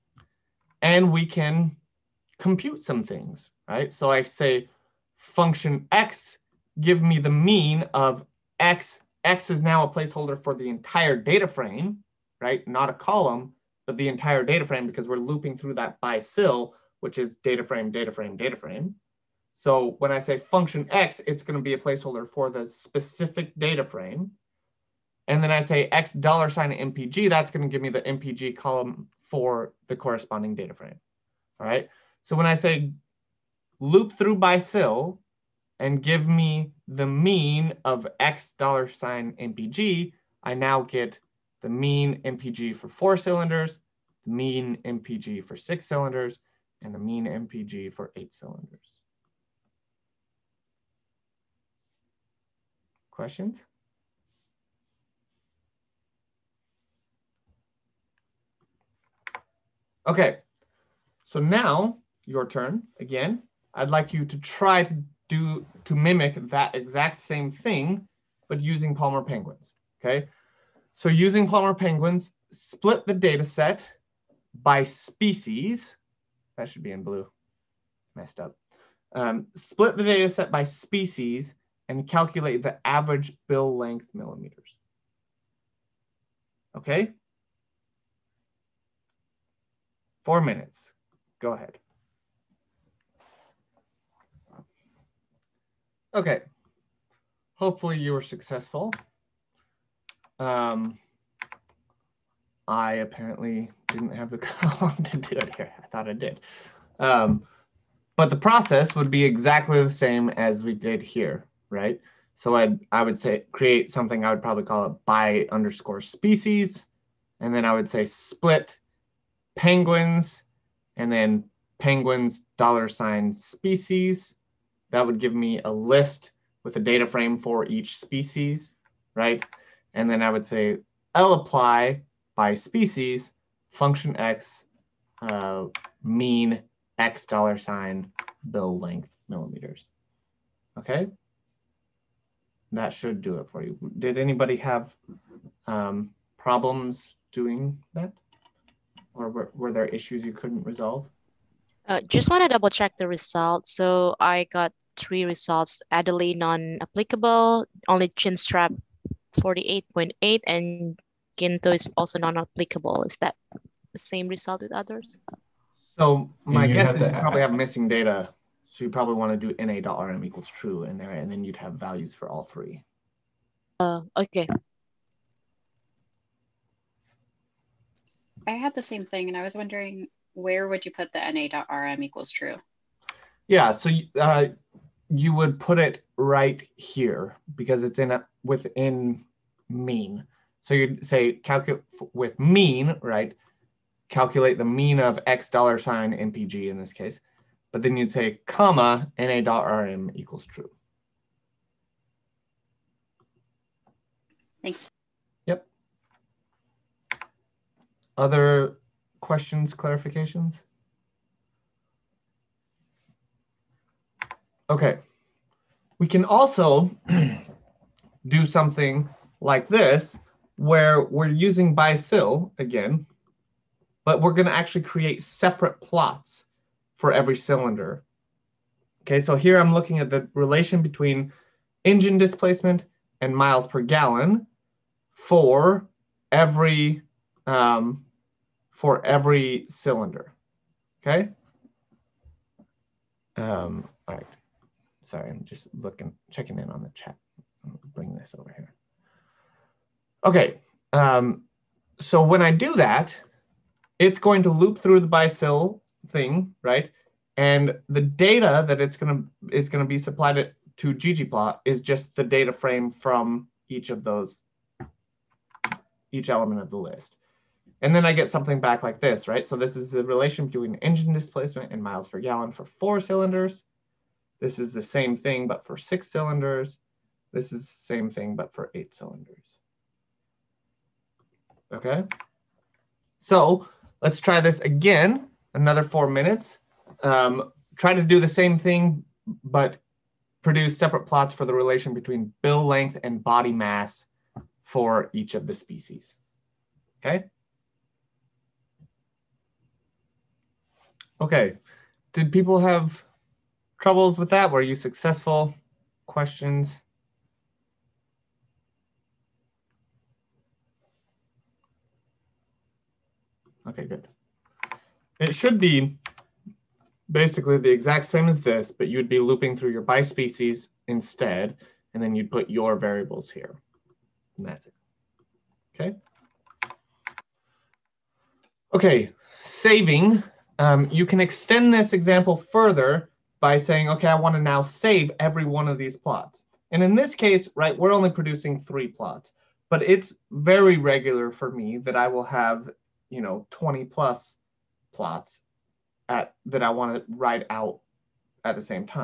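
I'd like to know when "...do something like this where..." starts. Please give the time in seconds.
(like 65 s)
218 s.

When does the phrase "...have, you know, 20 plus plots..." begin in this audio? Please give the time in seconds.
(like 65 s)
342 s.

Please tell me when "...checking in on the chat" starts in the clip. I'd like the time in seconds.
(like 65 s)
246 s.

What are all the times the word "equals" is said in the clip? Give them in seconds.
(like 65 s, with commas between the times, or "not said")
170 s, 182 s, 200 s.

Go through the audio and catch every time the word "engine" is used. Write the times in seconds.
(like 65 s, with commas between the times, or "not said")
231 s, 270 s.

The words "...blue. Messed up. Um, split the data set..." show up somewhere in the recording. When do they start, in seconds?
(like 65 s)
77 s.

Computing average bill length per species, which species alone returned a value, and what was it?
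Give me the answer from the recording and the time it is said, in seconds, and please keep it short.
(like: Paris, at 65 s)
Chinstrap, 48.8, at 158 s.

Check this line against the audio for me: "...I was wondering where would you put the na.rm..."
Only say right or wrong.
right.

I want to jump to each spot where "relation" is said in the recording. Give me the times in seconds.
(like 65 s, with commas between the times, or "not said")
230 s, 270 s, 291 s.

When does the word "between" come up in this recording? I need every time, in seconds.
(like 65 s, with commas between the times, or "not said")
230 s, 270 s, 291 s.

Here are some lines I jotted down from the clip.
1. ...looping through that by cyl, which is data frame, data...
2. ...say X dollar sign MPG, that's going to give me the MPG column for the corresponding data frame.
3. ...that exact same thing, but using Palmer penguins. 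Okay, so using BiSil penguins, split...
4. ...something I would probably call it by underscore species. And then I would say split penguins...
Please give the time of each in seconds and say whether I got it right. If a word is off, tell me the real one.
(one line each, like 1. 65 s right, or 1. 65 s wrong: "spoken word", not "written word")
1. 15 s right
2. 25 s right
3. 66 s wrong: "Palmer", not "BiSil"
4. 113 s right.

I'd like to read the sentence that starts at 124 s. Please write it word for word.
That would give me a list with a data frame for each species, right?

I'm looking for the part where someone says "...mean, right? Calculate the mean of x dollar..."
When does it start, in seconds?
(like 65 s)
192 s.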